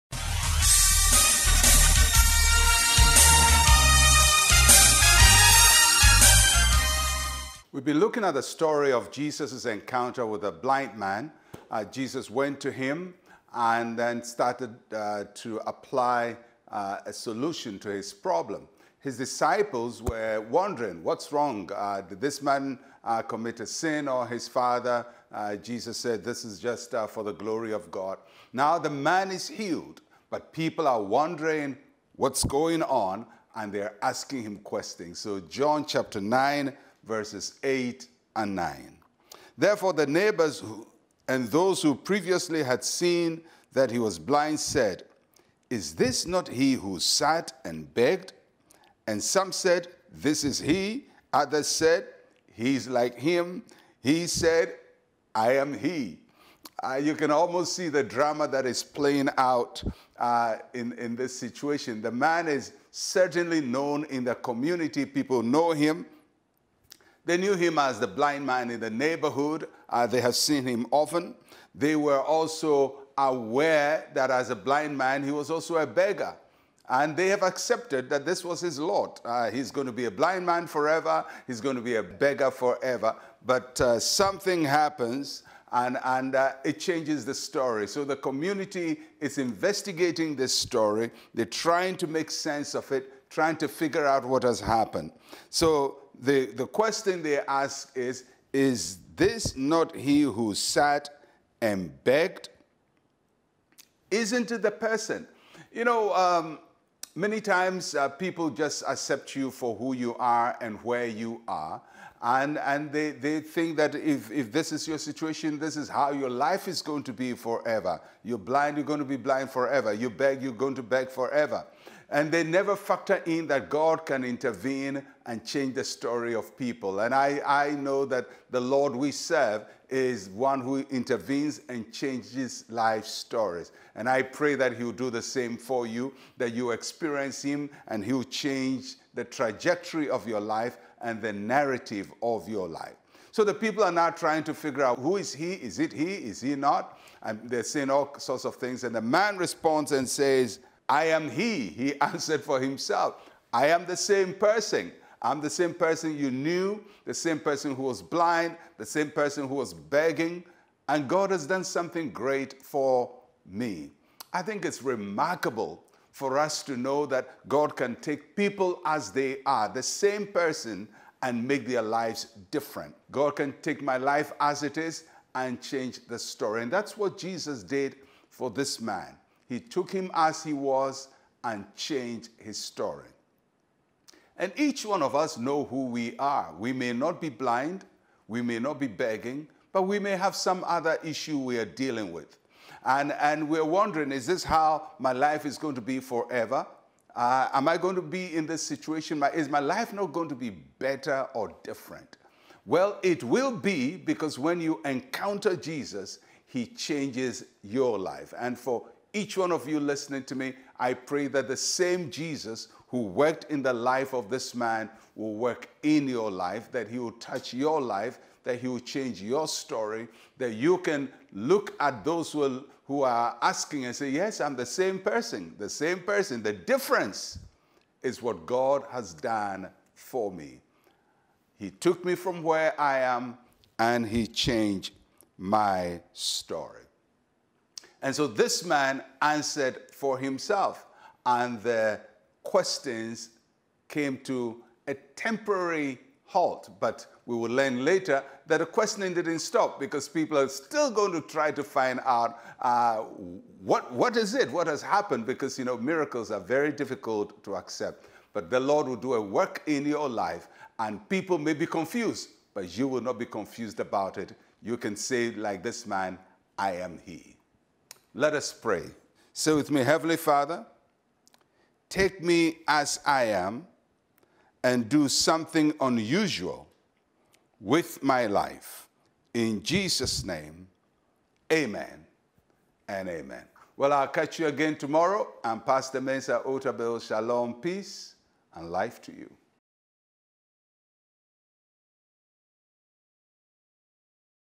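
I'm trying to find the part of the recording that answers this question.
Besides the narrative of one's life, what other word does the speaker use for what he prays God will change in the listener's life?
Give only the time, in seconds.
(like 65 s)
139 s.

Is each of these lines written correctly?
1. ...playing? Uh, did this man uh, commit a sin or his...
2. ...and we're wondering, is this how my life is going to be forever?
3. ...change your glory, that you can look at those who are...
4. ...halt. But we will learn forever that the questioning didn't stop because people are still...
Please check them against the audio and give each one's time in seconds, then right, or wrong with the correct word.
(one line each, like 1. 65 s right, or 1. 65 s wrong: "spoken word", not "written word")
1. 21 s wrong: "wrong", not "playing"
2. 193 s right
3. 218 s wrong: "story", not "glory"
4. 246 s wrong: "later", not "forever".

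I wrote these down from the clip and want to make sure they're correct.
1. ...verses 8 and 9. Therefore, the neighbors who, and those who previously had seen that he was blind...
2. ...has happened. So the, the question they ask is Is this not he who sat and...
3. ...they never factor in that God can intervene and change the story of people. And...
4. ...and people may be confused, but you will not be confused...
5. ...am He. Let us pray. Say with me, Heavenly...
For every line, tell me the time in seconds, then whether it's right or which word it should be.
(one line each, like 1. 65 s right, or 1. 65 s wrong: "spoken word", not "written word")
1. 37 s right
2. 94 s right
3. 122 s right
4. 260 s right
5. 266 s right.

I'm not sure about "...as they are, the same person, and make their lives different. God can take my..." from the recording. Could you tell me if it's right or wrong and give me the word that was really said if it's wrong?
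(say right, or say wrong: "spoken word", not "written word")
right.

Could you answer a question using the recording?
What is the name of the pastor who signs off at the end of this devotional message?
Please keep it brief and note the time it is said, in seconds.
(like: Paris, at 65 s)
Mensa Otabil, at 286 s.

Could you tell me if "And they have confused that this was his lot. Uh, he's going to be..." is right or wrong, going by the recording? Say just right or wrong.
wrong.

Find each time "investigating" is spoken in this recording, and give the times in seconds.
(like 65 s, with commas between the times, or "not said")
89 s.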